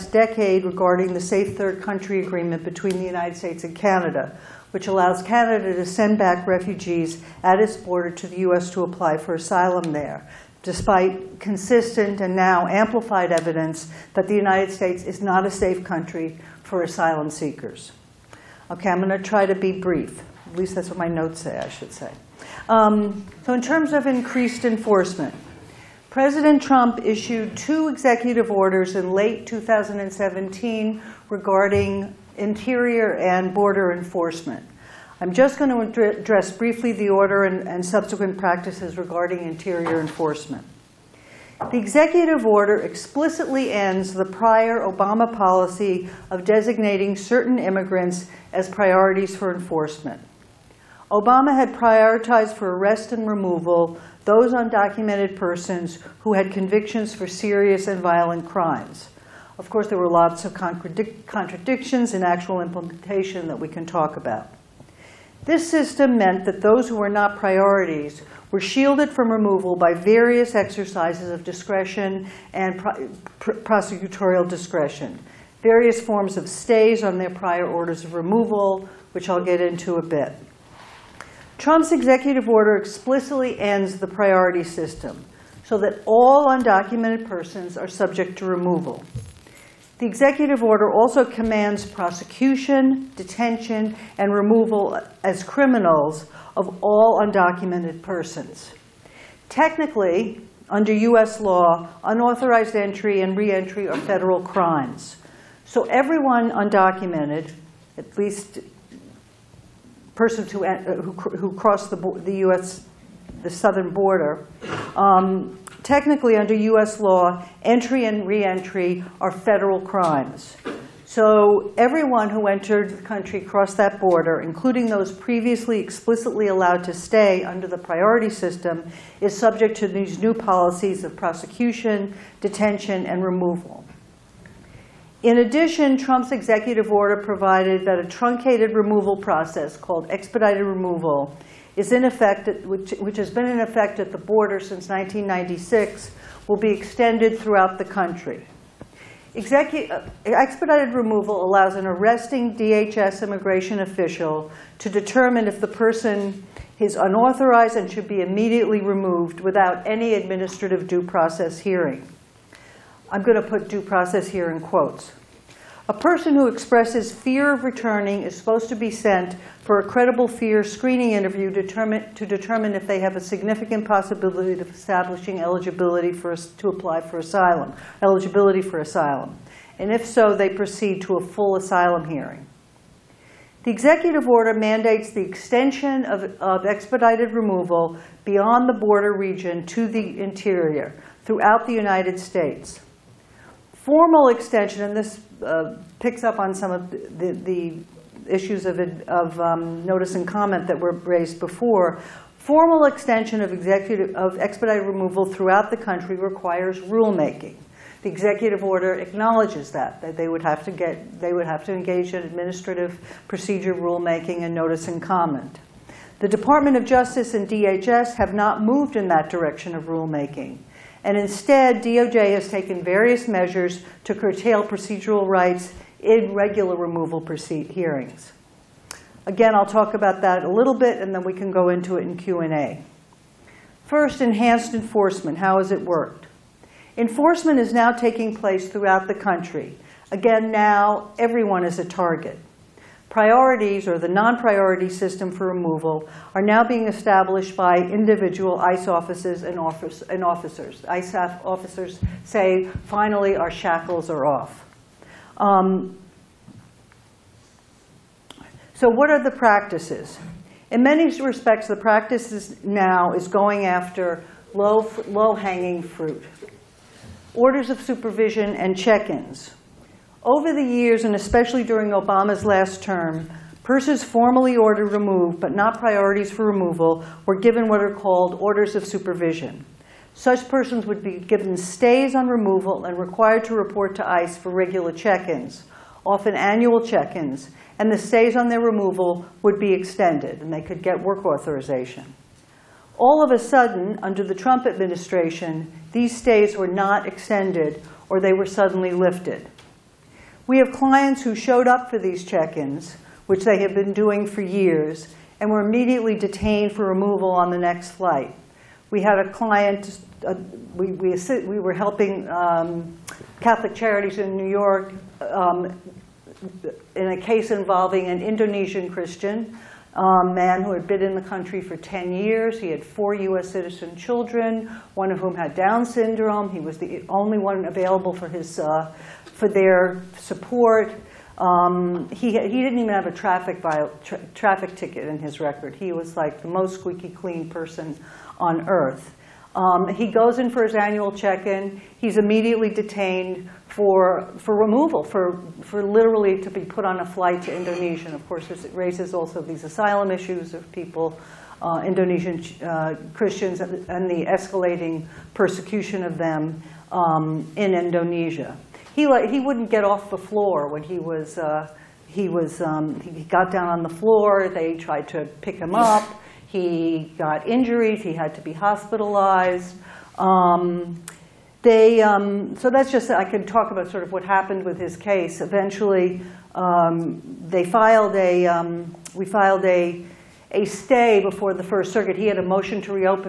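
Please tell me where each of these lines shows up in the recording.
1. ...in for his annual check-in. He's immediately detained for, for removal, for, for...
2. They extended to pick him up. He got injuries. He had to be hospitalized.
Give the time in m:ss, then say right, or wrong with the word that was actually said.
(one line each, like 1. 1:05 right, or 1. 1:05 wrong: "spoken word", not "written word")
1. 5:40 right
2. 6:04 wrong: "tried", not "extended".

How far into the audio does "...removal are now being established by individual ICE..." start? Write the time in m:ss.
4:05.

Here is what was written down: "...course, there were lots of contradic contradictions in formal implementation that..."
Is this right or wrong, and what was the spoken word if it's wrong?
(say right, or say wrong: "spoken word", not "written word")
wrong: "actual", not "formal".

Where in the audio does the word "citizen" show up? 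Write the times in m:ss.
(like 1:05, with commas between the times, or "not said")
5:23.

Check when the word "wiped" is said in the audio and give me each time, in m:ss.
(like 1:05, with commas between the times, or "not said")
not said.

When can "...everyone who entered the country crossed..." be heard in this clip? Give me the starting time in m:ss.
2:01.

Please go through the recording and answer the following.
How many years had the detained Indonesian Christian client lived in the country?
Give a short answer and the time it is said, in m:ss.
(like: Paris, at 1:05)
10, at 5:21.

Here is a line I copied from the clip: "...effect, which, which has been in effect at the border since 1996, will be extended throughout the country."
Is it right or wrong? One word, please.
right.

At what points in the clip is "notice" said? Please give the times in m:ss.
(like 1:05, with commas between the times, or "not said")
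3:19, 3:34.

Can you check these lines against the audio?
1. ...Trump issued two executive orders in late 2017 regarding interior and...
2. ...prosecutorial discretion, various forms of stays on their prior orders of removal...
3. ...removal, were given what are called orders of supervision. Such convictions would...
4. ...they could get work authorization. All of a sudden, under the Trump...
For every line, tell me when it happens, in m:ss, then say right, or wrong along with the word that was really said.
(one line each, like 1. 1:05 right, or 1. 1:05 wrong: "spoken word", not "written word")
1. 0:26 right
2. 1:13 right
3. 4:36 wrong: "persons", not "convictions"
4. 4:50 right.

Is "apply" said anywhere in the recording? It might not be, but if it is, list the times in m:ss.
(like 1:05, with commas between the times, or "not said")
0:08, 2:56.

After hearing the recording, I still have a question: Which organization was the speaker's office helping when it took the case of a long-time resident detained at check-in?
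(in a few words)
Catholic Charities.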